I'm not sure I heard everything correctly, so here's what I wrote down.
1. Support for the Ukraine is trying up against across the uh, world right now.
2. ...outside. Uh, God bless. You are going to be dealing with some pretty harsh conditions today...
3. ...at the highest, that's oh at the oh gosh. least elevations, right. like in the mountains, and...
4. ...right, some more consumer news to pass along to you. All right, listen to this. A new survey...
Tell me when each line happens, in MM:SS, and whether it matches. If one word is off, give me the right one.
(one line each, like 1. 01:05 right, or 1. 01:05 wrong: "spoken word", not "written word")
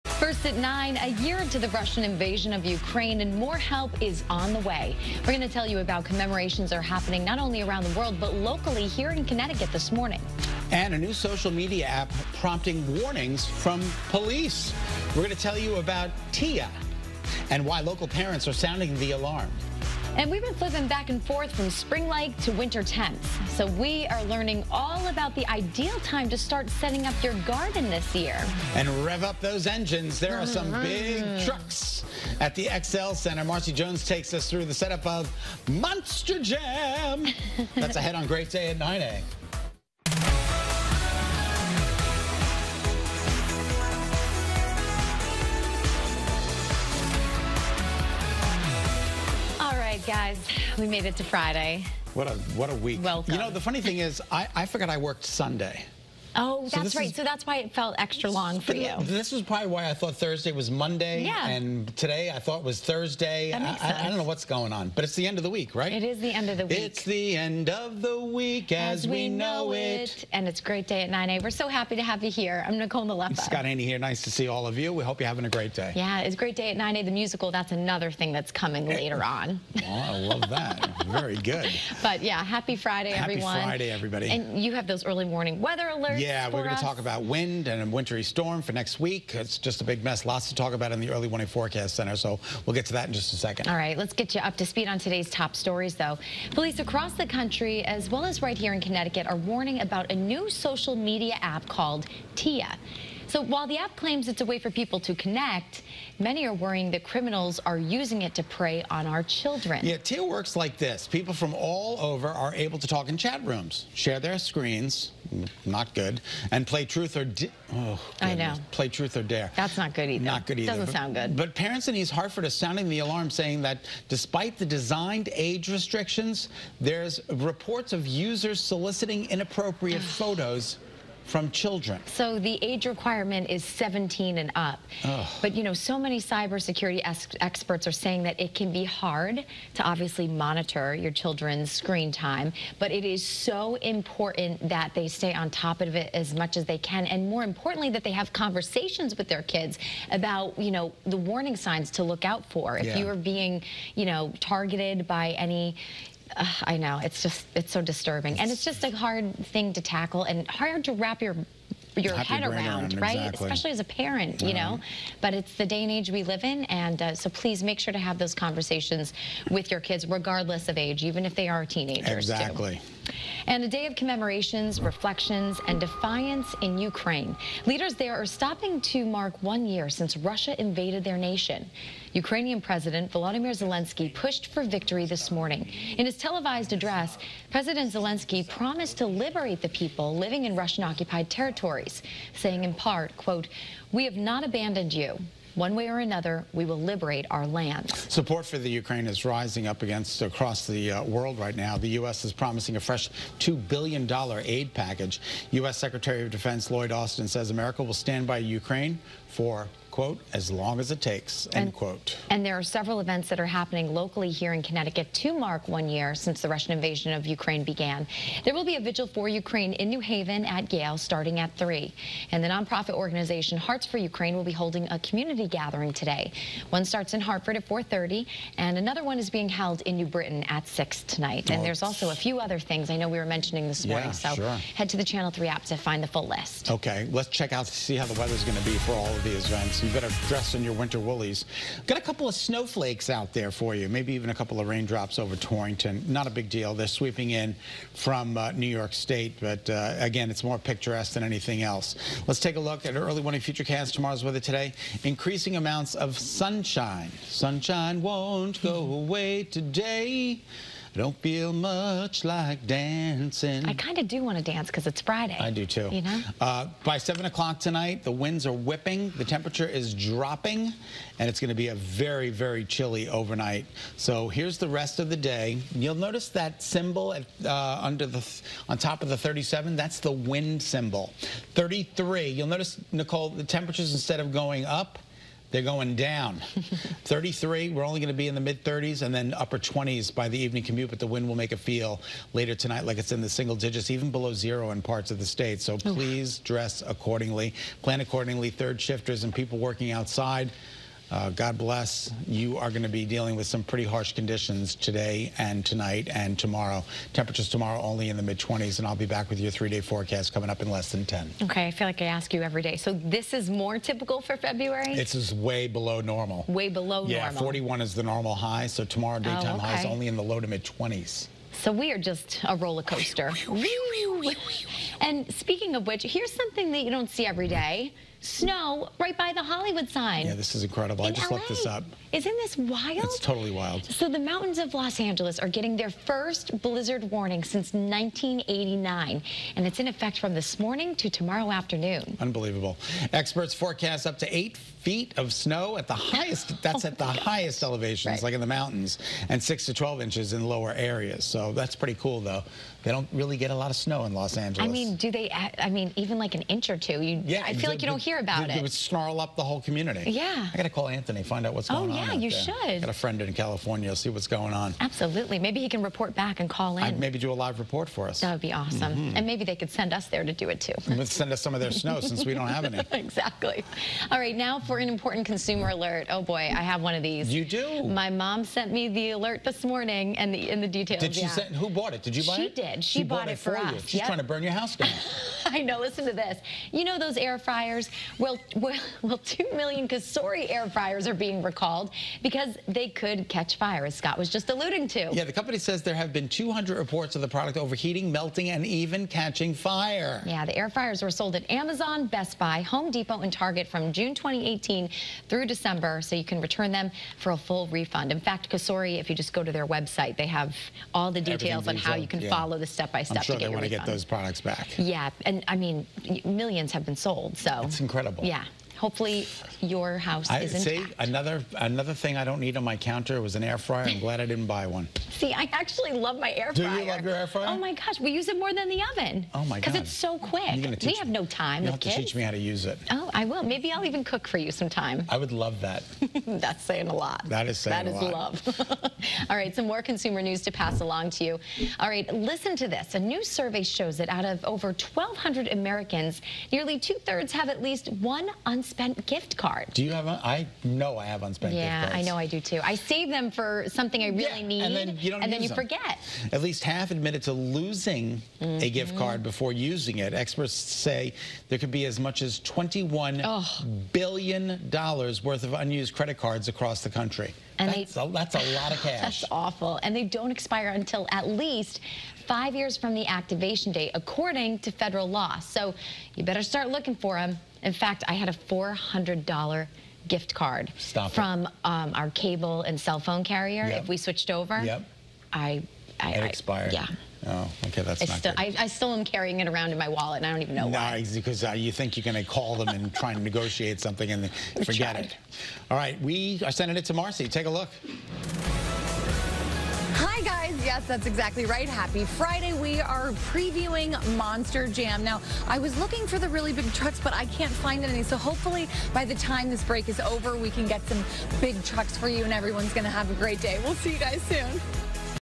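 1. 03:17 wrong: "rising", not "trying"
2. 04:59 right
3. 05:45 wrong: "highest", not "least"
4. 07:19 right.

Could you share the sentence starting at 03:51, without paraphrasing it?
And there's also a few other things I know we were mentioning this morning, yeah, so sure.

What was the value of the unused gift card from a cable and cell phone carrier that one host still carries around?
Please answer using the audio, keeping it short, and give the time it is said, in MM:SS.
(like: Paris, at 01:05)
$400, at 07:58.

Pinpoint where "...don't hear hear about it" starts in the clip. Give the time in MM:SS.
05:57.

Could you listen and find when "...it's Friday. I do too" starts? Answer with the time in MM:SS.
04:24.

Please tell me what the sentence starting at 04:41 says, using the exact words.
33, you'll notice, Nicole, the temperatures instead of going up, they're going down.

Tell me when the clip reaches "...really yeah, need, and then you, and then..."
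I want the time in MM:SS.
07:34.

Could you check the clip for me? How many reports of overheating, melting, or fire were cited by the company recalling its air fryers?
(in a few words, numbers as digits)
200.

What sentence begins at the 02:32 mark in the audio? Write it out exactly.
you are being you know targeted by any uh, I know.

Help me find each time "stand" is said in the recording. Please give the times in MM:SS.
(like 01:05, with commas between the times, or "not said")
03:27.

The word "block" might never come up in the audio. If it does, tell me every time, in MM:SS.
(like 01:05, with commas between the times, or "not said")
not said.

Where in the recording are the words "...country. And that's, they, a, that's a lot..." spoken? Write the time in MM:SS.
07:46.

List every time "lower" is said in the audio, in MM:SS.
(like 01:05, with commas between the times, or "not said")
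05:50.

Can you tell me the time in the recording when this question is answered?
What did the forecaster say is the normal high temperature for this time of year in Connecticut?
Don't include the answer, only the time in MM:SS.
05:17.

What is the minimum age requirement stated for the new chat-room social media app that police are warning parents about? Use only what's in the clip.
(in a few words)
17.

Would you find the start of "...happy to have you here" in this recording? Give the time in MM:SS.
01:11.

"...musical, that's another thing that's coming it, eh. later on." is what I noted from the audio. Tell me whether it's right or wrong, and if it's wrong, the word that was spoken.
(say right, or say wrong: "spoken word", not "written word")
right.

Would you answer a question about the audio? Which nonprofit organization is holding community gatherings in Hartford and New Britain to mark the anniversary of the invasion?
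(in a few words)
Hearts for Ukraine.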